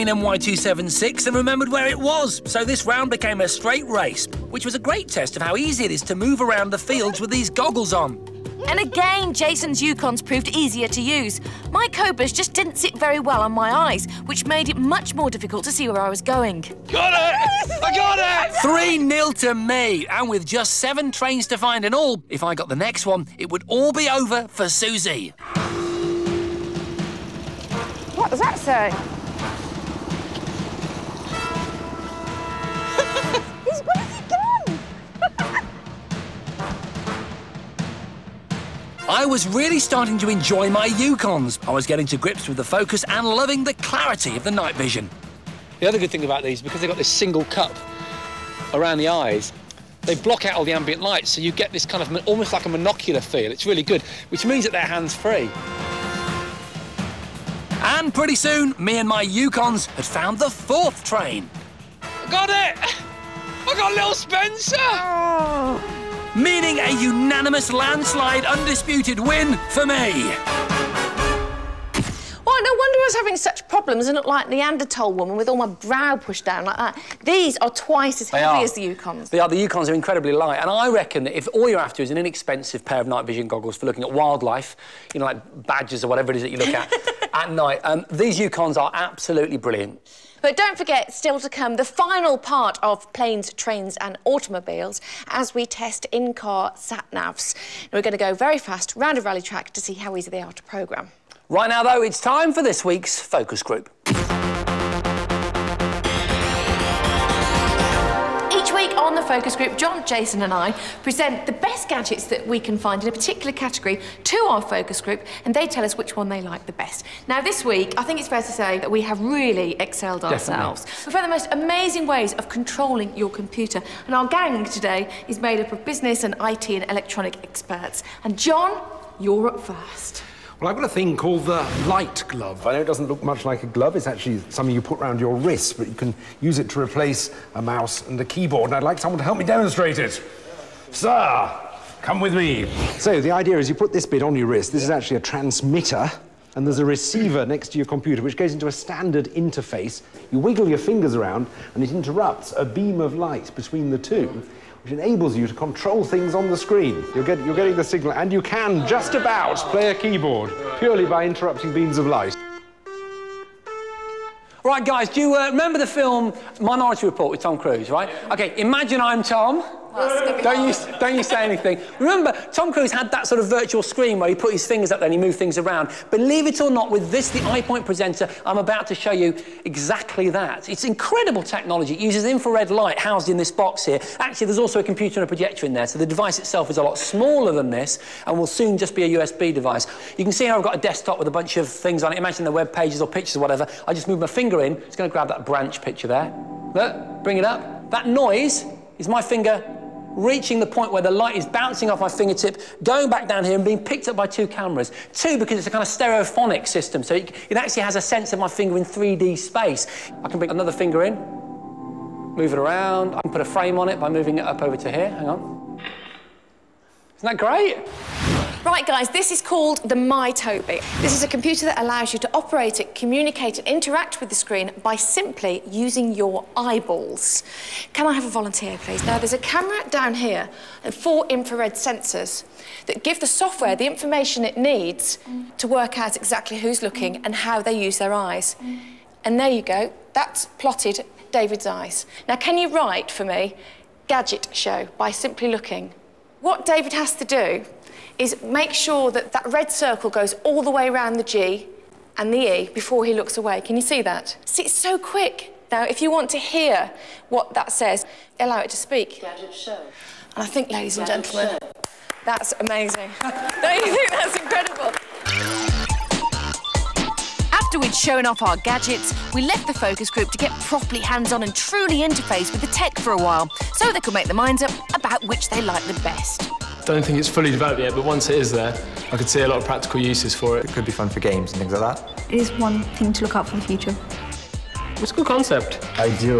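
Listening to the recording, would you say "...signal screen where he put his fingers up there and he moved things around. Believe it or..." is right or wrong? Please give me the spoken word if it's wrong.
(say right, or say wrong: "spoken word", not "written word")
wrong: "virtual", not "signal".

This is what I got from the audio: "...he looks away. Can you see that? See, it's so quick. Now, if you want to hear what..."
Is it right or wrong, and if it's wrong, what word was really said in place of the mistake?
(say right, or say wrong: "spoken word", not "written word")
right.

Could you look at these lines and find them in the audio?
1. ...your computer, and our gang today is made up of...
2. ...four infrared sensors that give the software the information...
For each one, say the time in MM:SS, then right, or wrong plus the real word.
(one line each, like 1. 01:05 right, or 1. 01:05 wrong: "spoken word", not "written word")
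1. 02:03 right
2. 03:50 right.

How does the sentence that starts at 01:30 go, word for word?
But don't forget, still to come, the final part of planes, trains and automobiles as we test in-car sat-navs.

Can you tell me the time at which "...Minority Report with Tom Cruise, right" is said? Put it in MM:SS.
02:46.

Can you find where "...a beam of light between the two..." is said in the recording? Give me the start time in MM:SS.
02:32.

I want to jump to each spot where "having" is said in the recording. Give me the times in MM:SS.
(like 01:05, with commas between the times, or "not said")
01:13.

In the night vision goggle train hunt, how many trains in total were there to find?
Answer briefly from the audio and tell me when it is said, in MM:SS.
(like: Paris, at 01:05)
7, at 00:20.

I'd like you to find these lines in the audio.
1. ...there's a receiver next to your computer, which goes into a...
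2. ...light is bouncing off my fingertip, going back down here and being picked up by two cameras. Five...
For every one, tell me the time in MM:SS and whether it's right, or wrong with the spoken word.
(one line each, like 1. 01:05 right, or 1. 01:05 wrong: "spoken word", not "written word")
1. 02:26 right
2. 03:21 wrong: "Two", not "Five".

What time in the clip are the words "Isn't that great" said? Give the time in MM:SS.
03:37.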